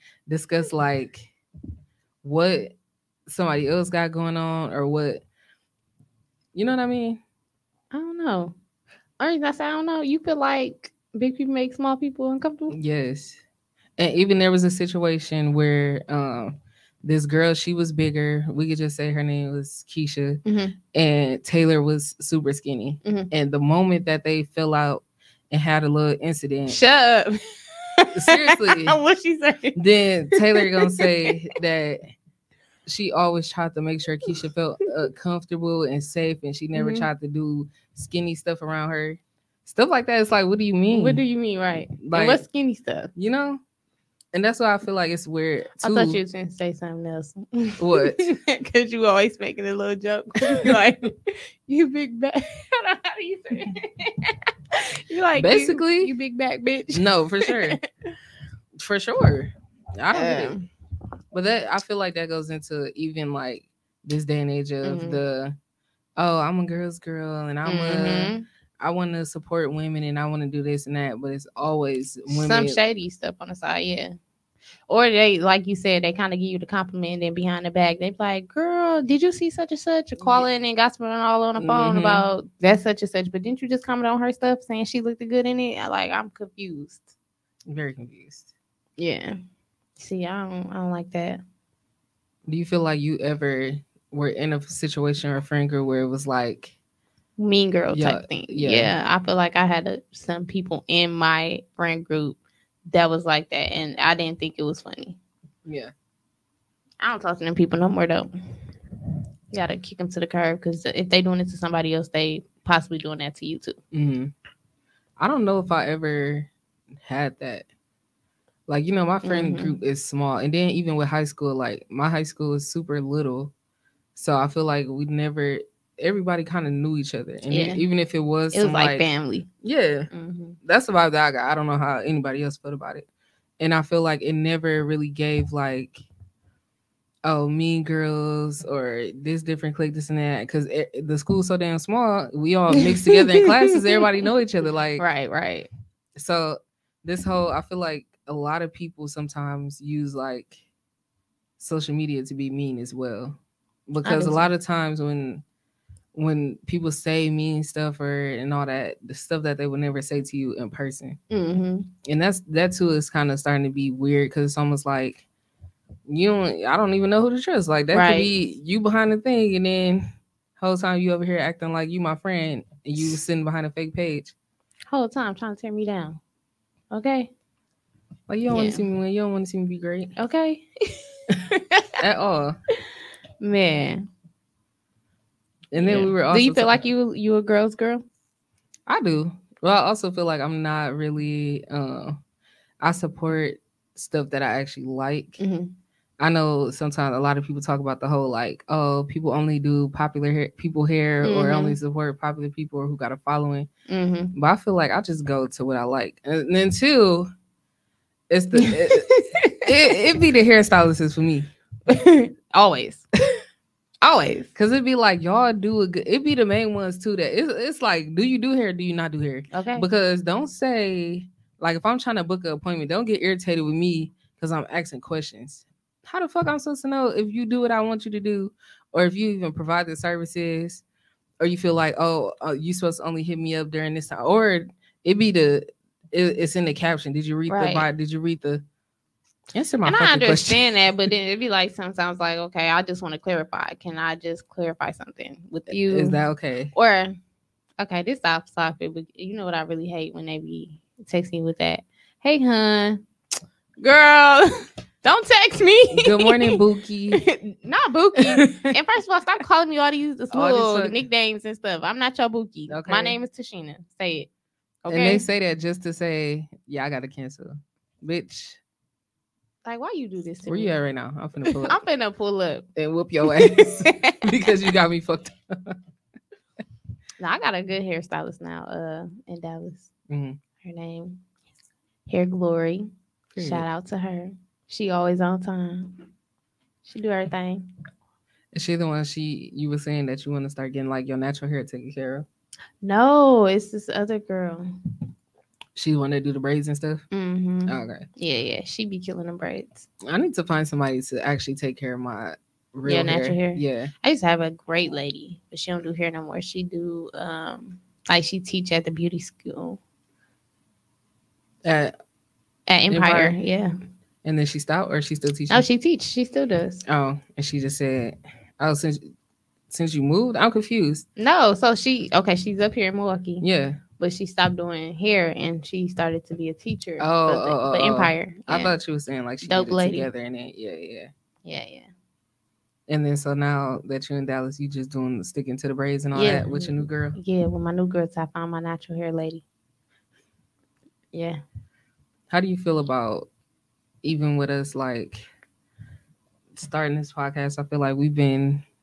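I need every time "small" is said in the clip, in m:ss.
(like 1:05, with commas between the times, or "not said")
0:11, 2:00, 2:21.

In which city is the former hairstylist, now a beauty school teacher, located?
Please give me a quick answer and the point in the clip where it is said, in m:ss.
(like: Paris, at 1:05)
Milwaukee, at 5:22.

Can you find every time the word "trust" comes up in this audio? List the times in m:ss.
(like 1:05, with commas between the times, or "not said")
2:47.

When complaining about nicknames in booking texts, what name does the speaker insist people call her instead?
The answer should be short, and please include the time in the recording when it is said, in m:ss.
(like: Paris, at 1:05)
Tashina, at 4:23.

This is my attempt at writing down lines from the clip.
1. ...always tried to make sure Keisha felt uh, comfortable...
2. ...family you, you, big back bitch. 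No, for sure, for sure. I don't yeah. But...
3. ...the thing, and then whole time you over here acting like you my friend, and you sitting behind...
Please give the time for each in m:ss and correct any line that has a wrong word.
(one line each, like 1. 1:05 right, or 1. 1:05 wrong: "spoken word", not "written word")
1. 0:33 right
2. 0:55 wrong: "basically", not "family"
3. 2:49 right.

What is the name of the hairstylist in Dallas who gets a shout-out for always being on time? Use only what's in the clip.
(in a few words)
Hair Glory.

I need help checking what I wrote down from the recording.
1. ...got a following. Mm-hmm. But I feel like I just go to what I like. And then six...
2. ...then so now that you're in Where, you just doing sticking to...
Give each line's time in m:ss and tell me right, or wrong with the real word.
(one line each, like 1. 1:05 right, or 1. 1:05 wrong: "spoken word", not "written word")
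1. 3:22 wrong: "two", not "six"
2. 5:33 wrong: "Dallas", not "Where".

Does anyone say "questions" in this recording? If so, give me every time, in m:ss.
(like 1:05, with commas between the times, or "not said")
3:44, 4:00.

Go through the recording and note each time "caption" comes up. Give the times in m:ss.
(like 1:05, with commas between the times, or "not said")
3:56.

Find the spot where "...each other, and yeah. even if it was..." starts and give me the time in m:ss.
2:06.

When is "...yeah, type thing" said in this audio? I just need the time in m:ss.
1:37.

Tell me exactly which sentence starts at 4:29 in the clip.
Like, why you do this to Where me?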